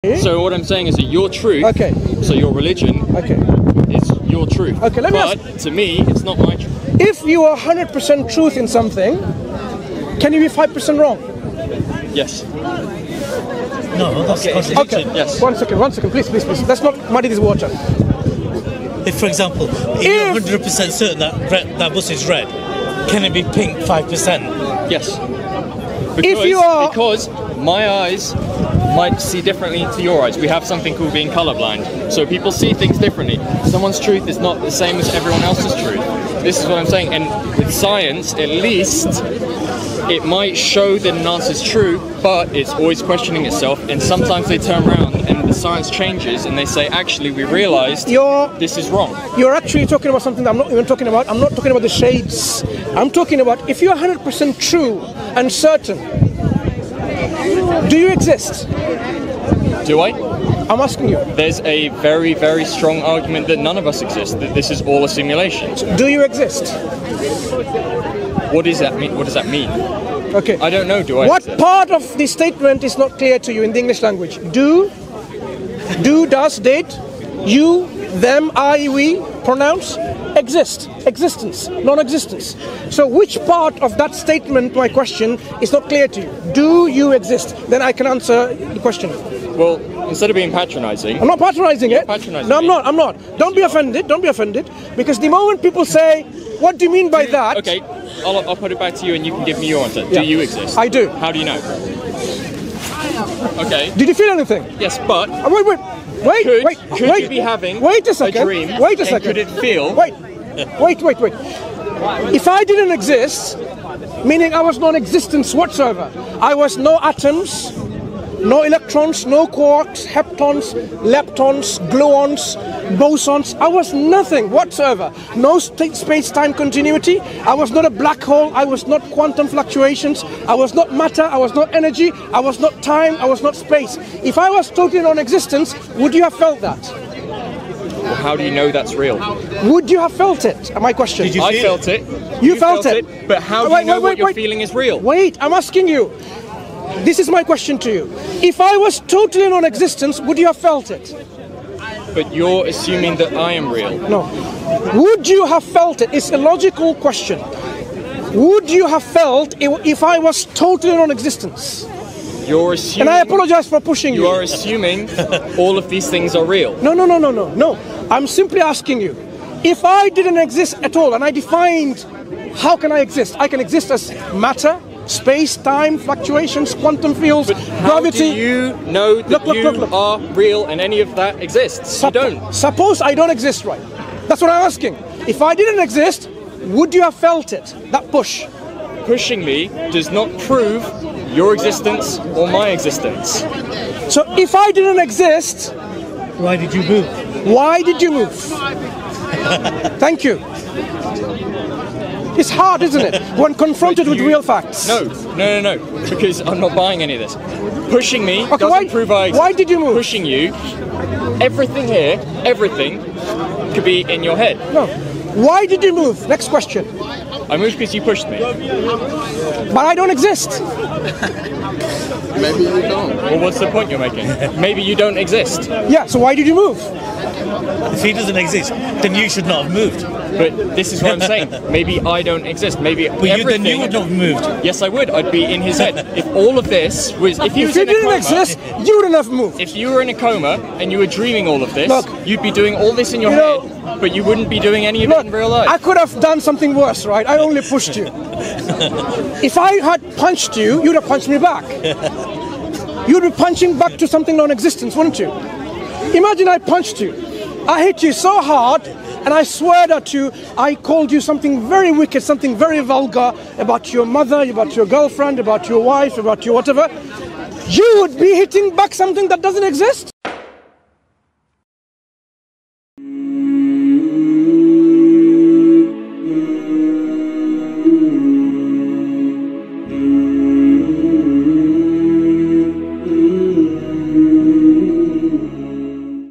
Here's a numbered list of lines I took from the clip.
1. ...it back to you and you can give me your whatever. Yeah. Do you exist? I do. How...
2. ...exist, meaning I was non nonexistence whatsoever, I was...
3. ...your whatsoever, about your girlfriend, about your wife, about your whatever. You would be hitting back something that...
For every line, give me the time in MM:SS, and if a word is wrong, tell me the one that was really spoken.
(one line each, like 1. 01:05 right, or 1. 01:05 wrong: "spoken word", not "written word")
1. 01:38 wrong: "answer", not "whatever"
2. 01:52 wrong: "existence", not "nonexistence"
3. 04:23 wrong: "mother", not "whatsoever".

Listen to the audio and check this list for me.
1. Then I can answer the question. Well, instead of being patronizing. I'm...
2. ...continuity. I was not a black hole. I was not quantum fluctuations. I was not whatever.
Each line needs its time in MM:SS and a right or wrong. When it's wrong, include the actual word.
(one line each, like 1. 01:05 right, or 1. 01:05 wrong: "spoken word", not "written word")
1. 01:27 right
2. 02:06 wrong: "matter", not "whatever".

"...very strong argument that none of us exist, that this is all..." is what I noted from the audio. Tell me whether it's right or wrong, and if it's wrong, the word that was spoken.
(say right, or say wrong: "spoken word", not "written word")
right.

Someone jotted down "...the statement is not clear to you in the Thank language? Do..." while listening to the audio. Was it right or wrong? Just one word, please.
wrong.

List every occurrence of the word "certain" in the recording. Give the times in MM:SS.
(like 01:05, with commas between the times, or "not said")
00:20, 00:55.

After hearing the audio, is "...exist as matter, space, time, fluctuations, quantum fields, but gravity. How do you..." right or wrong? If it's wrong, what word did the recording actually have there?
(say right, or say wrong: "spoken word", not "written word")
right.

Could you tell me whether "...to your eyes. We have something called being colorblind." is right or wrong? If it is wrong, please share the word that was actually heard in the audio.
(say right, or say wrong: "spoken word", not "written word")
right.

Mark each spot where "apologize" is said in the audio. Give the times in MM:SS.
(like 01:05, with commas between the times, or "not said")
02:43.